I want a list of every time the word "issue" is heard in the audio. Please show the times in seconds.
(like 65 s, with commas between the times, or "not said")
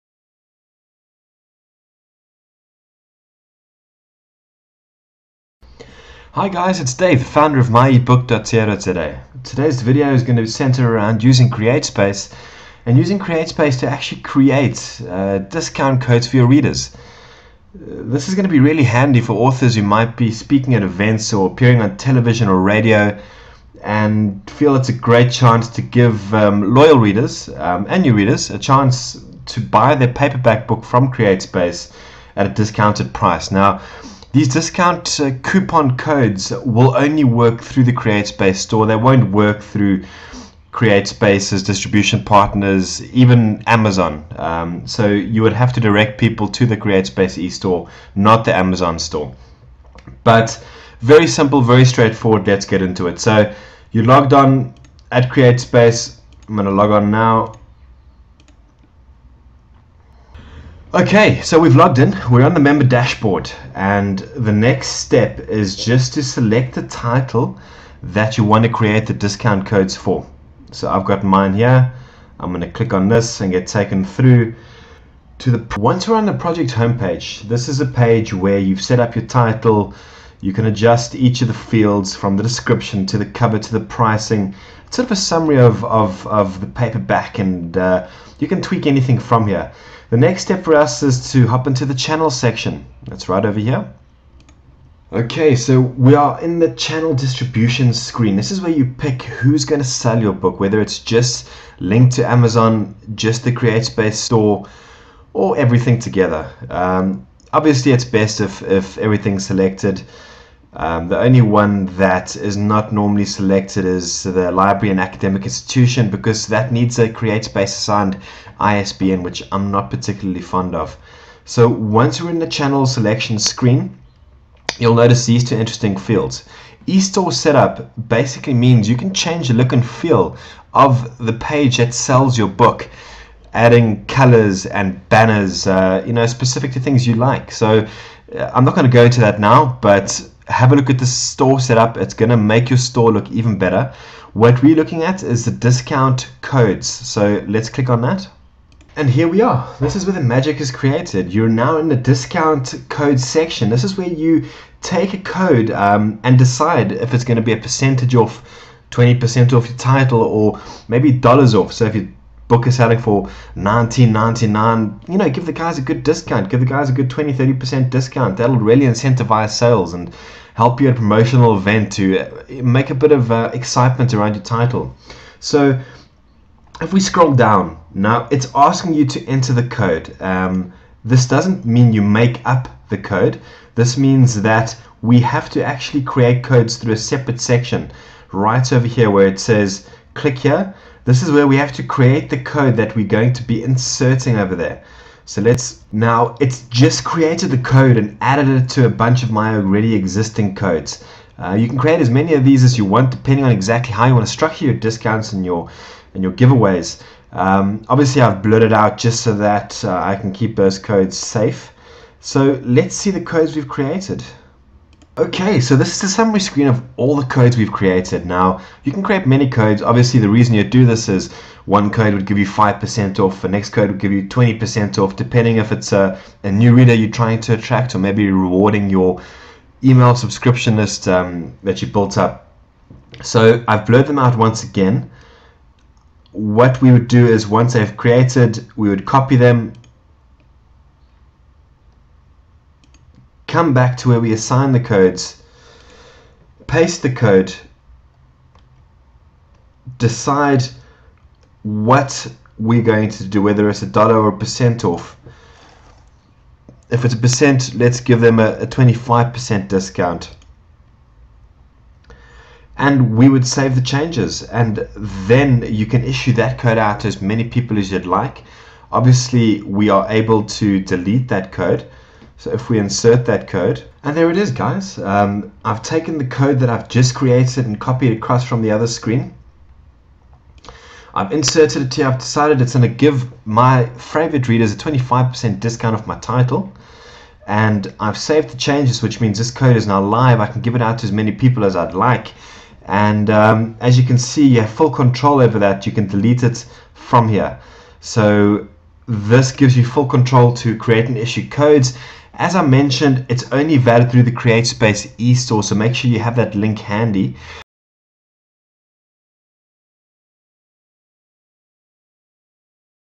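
266 s, 301 s.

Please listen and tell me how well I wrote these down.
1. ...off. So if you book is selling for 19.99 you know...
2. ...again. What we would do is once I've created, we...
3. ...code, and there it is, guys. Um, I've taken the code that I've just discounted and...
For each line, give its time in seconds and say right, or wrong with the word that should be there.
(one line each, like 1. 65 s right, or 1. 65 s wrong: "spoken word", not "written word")
1. 161 s right
2. 234 s right
3. 273 s wrong: "created", not "discounted".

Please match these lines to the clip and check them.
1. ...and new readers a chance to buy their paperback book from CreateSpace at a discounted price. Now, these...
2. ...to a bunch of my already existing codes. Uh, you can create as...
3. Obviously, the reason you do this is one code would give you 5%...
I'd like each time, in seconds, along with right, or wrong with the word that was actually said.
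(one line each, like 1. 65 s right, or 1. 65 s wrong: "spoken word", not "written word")
1. 27 s right
2. 198 s right
3. 219 s right.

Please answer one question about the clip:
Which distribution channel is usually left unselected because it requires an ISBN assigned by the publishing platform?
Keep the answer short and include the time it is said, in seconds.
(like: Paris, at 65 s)
Library and academic institution, at 114 s.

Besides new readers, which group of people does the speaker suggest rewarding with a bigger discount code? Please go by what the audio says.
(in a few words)
Email subscription list.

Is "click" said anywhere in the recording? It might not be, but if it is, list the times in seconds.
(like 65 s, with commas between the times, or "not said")
72 s, 147 s, 190 s.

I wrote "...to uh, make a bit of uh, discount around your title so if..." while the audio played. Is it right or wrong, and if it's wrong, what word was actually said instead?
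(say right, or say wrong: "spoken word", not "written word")
wrong: "excitement", not "discount".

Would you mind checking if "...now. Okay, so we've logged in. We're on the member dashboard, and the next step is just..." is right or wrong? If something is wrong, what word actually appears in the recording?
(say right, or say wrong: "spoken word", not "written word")
right.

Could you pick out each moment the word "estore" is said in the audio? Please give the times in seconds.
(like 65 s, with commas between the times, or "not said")
47 s, 126 s, 305 s.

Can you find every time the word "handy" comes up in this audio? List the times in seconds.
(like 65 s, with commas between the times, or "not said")
18 s, 306 s.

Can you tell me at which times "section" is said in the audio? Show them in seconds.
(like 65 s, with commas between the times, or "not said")
92 s, 153 s, 187 s.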